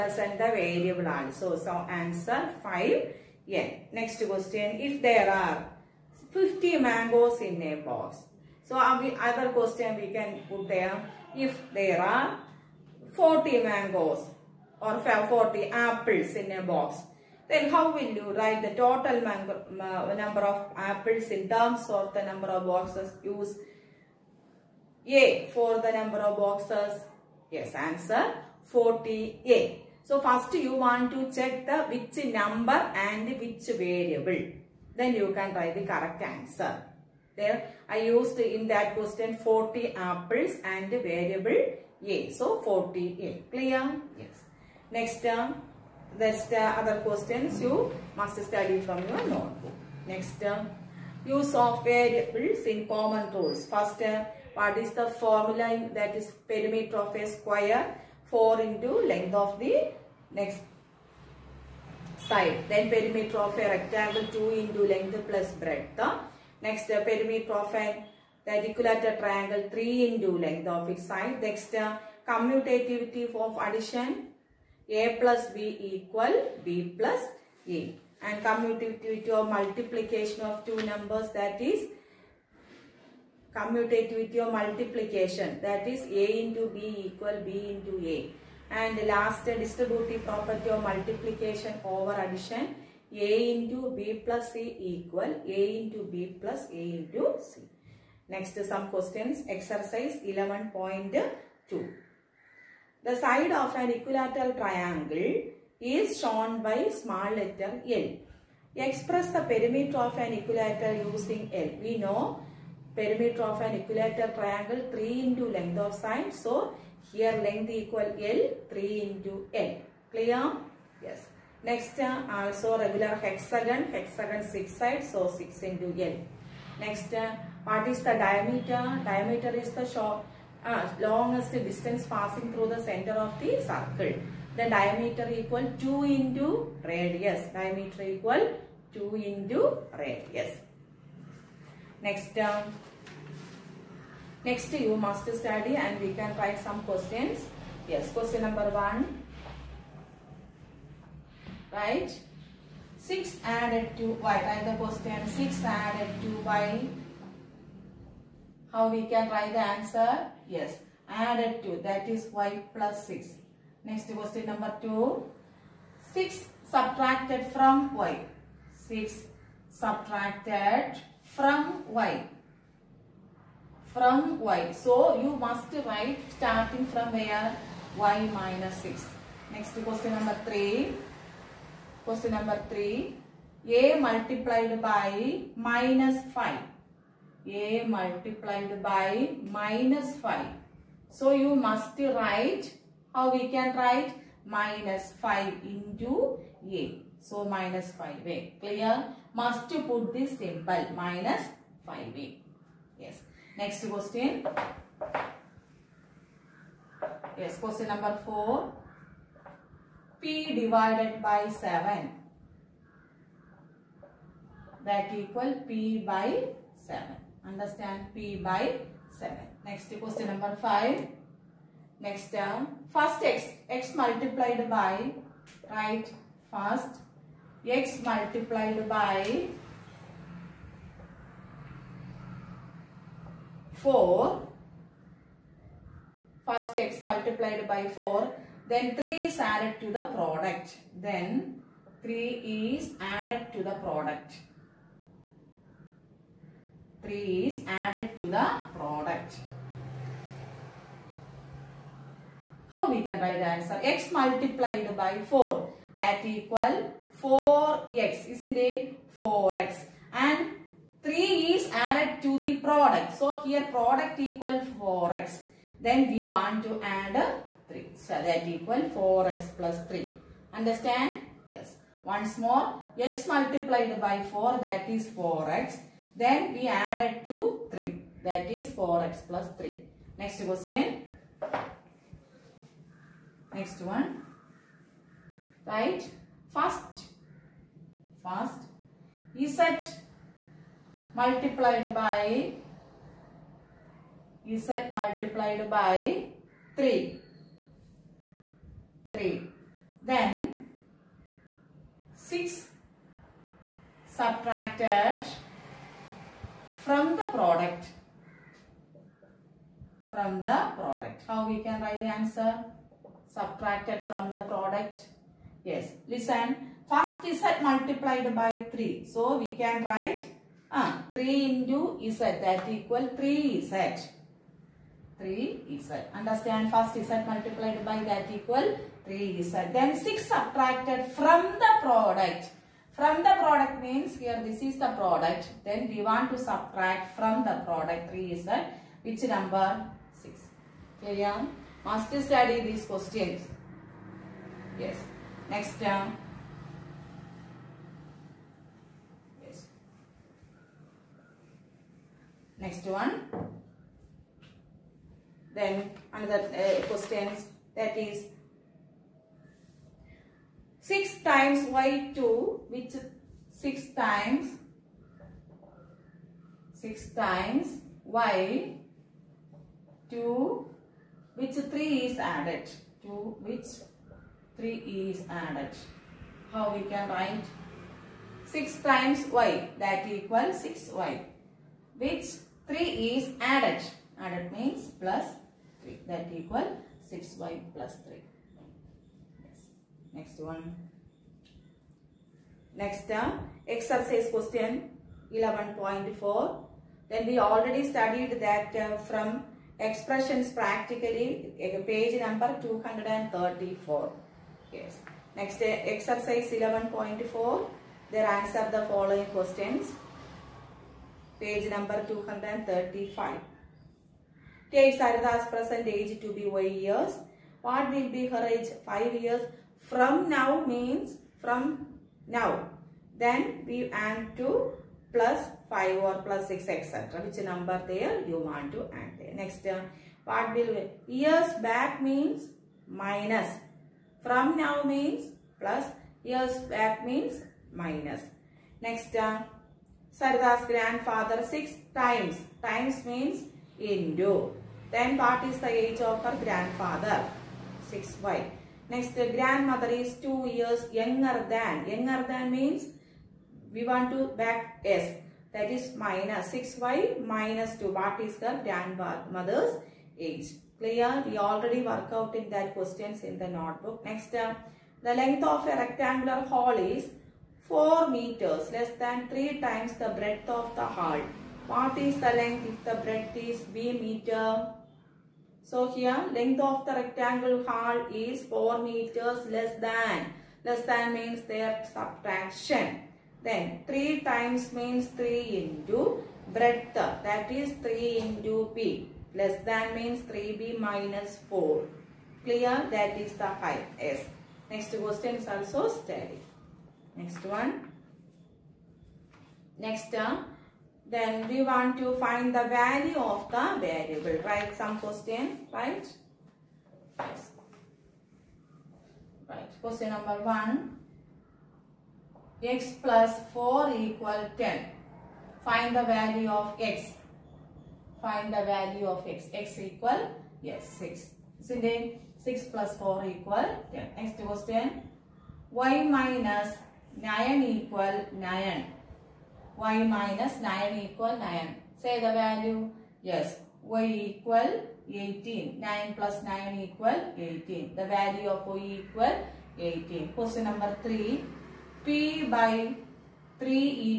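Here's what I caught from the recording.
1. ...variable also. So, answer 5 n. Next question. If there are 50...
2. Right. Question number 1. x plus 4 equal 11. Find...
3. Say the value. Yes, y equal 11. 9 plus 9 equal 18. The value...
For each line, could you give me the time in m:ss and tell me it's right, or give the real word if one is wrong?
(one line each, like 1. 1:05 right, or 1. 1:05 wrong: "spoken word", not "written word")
1. 0:00 right
2. 8:29 wrong: "10", not "11"
3. 8:51 wrong: "18", not "11".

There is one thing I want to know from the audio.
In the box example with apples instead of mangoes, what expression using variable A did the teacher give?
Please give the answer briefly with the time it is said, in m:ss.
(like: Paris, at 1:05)
40A, at 0:27.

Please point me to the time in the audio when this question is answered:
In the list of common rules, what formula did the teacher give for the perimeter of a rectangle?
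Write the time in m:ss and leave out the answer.
1:04.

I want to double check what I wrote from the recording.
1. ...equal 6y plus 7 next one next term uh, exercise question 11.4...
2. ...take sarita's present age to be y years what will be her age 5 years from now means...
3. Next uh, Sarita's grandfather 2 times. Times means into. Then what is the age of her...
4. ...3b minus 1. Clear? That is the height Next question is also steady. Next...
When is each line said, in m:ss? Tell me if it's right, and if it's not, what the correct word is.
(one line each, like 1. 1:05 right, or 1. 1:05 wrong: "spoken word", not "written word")
1. 6:26 wrong: "3", not "7"
2. 6:54 right
3. 7:18 wrong: "6", not "2"
4. 8:10 wrong: "4", not "1".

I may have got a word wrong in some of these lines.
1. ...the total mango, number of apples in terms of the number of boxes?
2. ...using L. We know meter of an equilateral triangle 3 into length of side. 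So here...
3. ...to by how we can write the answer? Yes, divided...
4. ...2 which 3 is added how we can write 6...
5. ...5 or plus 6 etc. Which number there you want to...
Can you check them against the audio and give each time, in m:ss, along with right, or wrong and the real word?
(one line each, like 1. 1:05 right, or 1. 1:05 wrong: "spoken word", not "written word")
1. 0:18 right
2. 1:51 wrong: "perimeter", not "meter"
3. 2:36 wrong: "added", not "divided"
4. 6:13 right
5. 7:05 right.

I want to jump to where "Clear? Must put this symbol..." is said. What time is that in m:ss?
3:18.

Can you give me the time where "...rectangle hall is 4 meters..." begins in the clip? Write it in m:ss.
7:56.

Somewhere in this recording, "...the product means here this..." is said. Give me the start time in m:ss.
5:33.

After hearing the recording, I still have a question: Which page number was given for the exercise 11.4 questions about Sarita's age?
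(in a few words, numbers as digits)
235.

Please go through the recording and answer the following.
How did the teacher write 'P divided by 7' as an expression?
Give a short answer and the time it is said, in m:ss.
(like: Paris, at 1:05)
P by 7, at 3:34.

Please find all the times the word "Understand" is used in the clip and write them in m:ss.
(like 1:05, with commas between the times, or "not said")
3:37, 4:30, 5:26.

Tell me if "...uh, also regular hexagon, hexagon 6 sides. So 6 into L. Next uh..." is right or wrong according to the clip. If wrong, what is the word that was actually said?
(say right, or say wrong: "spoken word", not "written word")
right.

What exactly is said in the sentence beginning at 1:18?
And commutativity of multiplication of two numbers that is commutativity of multiplication that is a into b equal b into a.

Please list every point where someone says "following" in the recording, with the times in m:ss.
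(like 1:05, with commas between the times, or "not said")
6:48.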